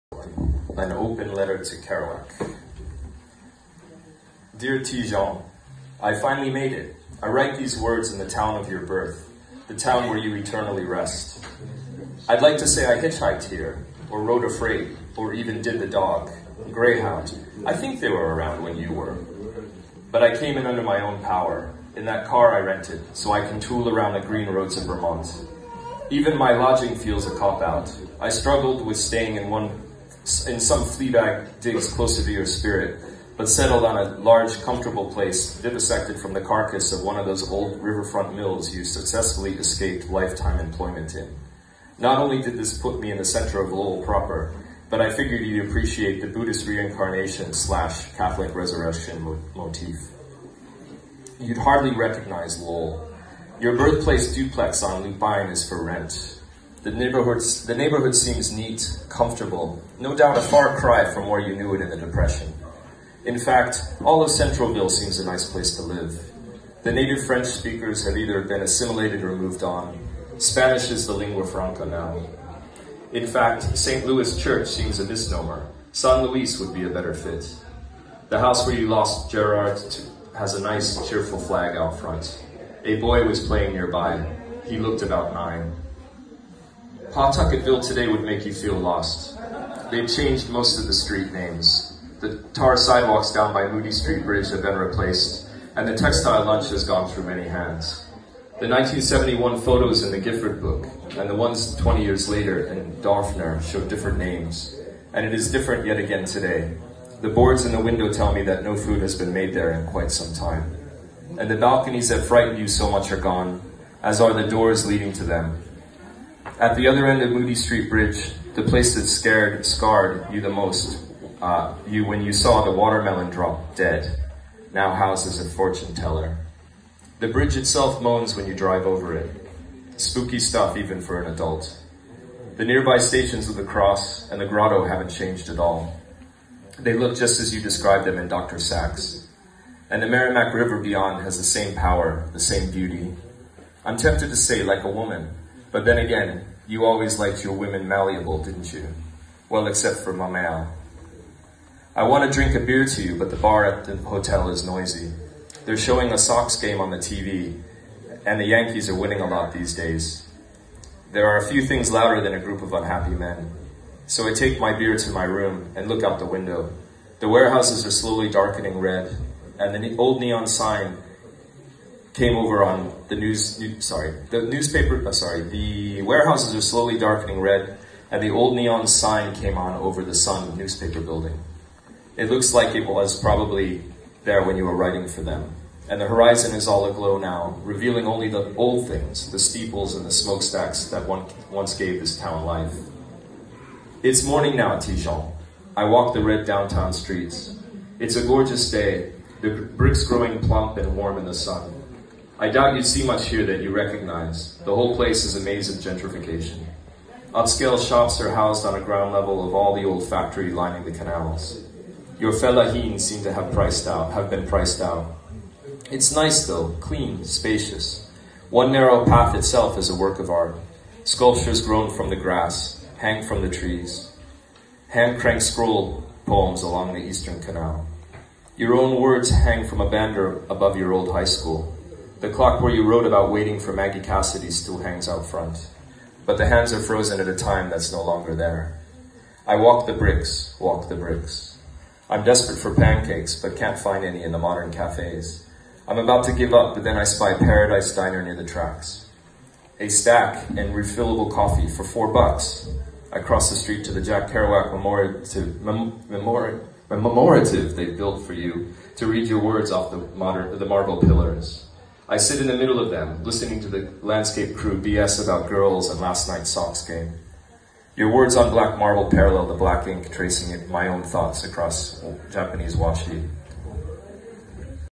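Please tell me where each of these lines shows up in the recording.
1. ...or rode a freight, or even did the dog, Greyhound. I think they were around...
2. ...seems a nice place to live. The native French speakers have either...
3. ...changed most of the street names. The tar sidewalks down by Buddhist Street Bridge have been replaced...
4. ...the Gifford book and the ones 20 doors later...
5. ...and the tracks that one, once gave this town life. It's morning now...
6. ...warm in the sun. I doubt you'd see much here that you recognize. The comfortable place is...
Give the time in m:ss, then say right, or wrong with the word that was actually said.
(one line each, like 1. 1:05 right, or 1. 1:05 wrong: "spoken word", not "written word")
1. 0:14 right
2. 1:04 right
3. 1:30 wrong: "Moody", not "Buddhist"
4. 1:40 wrong: "years", not "doors"
5. 3:09 wrong: "smokestacks", not "tracks"
6. 3:20 wrong: "whole", not "comfortable".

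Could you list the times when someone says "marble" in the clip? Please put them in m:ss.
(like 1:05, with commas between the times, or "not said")
4:20, 4:28.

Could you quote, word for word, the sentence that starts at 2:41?
There are a few things louder than a group of unhappy men.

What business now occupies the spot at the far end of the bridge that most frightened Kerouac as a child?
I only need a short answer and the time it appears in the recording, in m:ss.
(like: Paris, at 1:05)
a fortune teller, at 2:05.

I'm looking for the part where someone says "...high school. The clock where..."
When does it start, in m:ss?
3:51.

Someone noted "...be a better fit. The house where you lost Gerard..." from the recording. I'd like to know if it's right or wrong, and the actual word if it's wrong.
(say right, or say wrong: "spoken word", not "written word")
right.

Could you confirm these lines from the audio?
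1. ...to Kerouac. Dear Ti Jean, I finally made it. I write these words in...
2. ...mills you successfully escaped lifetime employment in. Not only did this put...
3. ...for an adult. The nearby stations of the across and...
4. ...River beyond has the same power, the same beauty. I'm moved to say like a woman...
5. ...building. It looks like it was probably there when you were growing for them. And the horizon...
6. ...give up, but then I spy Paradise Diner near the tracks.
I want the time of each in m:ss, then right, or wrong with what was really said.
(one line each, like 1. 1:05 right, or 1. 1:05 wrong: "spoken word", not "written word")
1. 0:01 right
2. 0:38 right
3. 2:11 wrong: "cross", not "across"
4. 2:20 wrong: "tempted", not "moved"
5. 3:01 wrong: "writing", not "growing"
6. 4:06 right.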